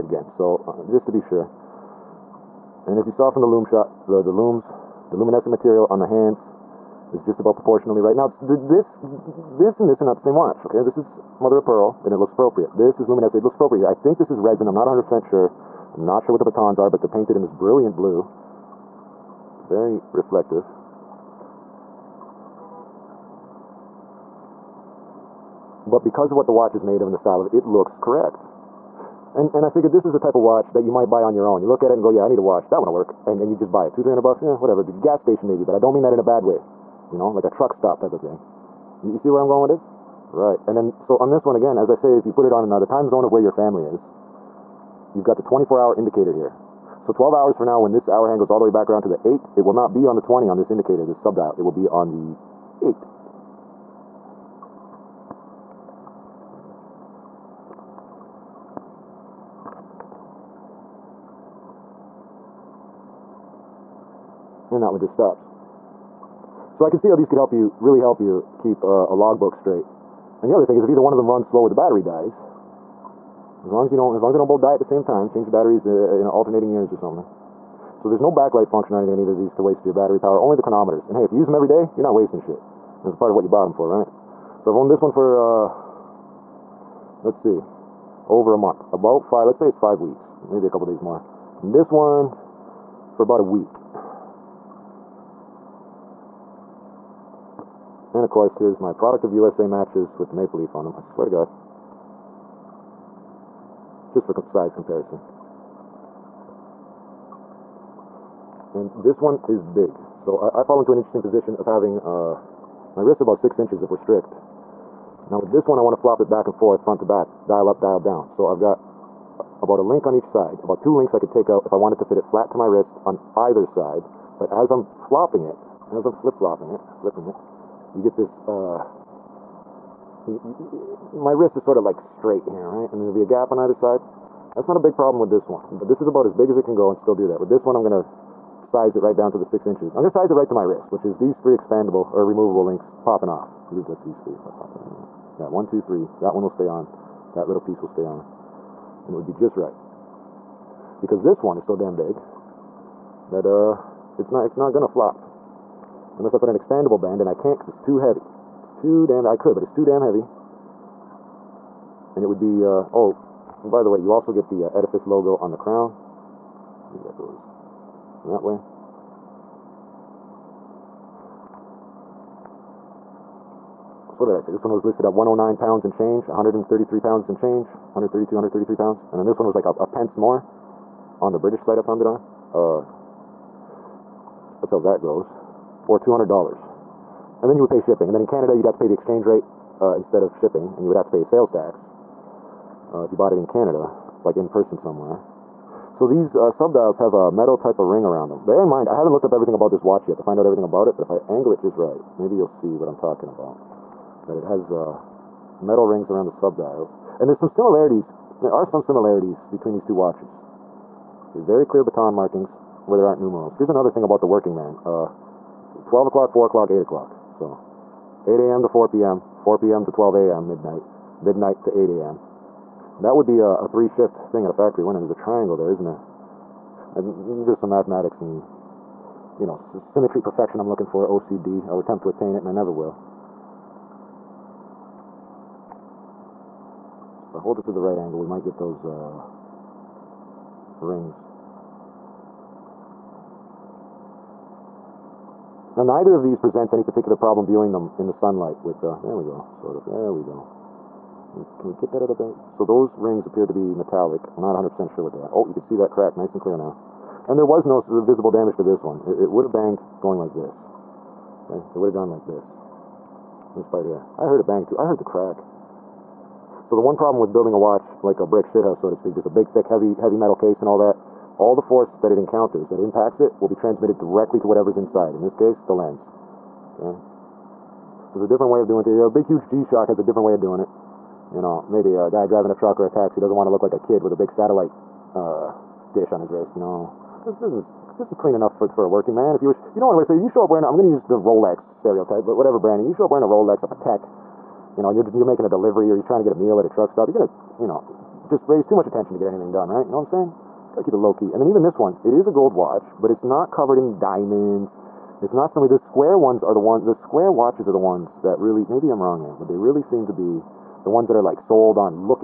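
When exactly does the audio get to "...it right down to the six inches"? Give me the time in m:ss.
2:18.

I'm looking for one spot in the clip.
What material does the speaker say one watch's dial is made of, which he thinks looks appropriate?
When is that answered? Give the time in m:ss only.
0:11.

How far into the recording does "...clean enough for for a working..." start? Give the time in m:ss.
4:48.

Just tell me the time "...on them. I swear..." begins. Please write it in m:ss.
1:40.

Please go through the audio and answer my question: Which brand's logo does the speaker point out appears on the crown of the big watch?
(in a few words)
Edifice.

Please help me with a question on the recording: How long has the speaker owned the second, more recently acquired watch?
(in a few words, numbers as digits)
about a week.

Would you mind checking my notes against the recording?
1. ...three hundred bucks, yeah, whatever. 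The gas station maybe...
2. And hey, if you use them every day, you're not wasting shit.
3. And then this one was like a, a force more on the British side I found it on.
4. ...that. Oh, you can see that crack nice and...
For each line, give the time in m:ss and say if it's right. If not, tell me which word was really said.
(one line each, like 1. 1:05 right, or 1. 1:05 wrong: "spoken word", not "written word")
1. 0:34 right
2. 1:21 right
3. 2:59 wrong: "pence", not "force"
4. 4:15 right.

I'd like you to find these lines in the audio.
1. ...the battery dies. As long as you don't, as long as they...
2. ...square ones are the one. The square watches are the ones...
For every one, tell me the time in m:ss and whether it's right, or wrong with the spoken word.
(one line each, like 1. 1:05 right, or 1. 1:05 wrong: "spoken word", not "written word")
1. 1:11 right
2. 5:05 right.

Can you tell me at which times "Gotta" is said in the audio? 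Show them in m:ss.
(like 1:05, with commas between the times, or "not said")
5:00.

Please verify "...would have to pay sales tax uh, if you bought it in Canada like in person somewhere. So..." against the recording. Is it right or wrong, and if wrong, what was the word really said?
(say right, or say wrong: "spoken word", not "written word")
right.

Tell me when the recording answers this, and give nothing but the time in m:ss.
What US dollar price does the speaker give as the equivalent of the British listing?
3:05.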